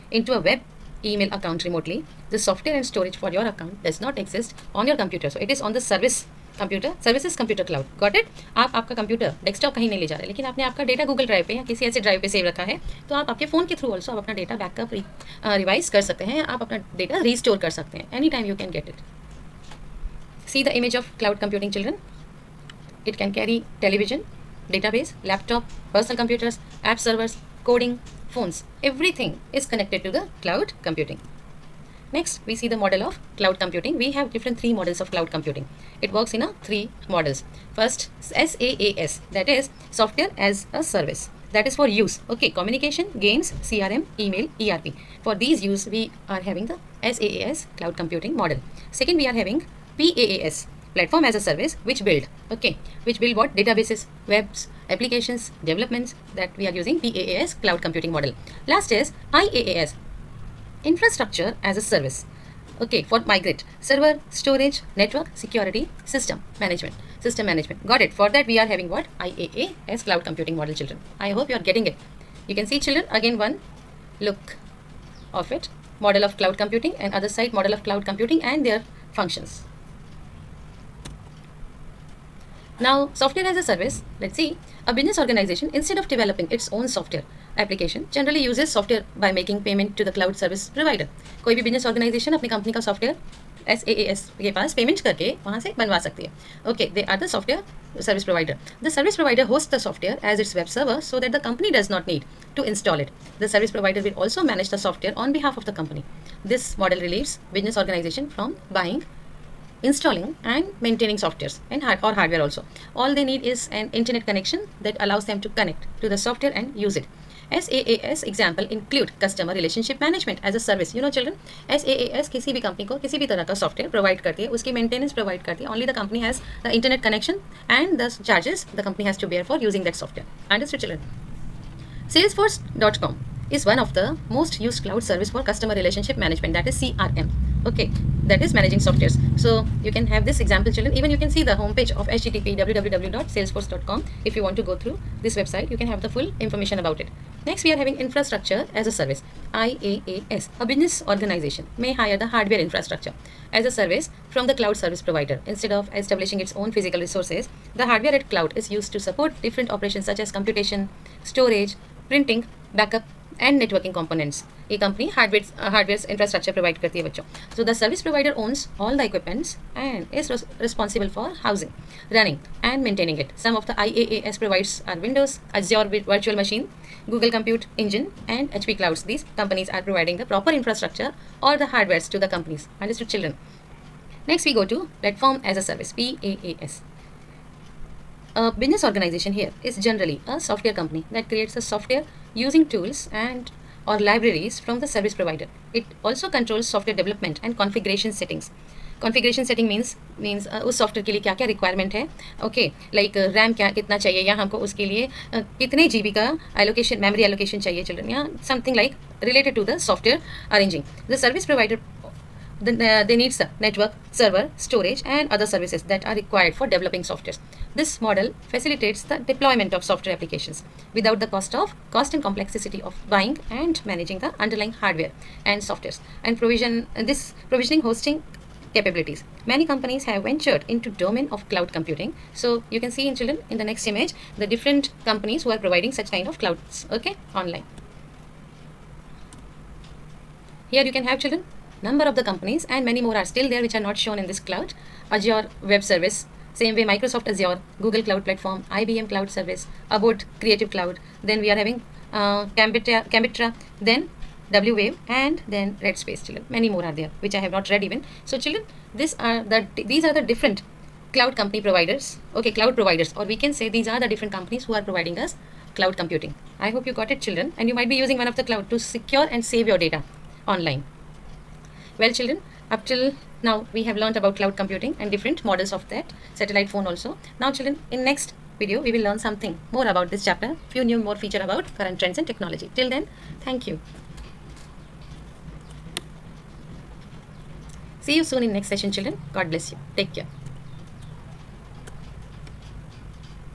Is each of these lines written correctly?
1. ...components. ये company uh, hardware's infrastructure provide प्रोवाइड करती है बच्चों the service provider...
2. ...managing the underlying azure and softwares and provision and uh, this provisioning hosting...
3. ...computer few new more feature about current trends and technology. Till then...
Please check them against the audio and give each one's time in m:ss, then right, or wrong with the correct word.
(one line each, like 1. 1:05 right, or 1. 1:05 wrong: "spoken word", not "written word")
1. 2:43 right
2. 3:43 wrong: "hardware", not "azure"
3. 4:40 wrong: "chapter", not "computer".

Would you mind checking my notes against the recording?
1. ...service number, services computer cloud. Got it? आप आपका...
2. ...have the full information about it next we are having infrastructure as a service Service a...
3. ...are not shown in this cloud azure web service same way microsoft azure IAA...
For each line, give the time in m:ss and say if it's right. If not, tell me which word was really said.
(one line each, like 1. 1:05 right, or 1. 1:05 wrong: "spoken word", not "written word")
1. 0:05 wrong: "computer", not "number"
2. 2:25 wrong: "IaaS", not "Service"
3. 4:03 wrong: "Google", not "IAA".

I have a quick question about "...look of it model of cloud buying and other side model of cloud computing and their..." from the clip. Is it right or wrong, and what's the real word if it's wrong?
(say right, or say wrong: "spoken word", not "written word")
wrong: "computing", not "buying".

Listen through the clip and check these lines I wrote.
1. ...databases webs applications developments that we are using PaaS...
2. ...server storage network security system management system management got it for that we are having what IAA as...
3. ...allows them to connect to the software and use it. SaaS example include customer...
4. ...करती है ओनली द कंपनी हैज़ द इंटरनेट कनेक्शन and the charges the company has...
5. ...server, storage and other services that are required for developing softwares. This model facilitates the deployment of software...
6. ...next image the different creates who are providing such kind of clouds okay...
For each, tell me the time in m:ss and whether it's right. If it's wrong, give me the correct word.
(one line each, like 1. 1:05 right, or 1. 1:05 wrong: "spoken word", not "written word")
1. 0:53 right
2. 1:03 right
3. 1:54 right
4. 2:05 right
5. 3:34 right
6. 3:53 wrong: "companies", not "creates".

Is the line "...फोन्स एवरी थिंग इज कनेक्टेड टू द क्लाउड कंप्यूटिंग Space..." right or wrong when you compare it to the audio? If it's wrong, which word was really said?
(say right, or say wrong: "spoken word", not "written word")
wrong: "Next", not "Space".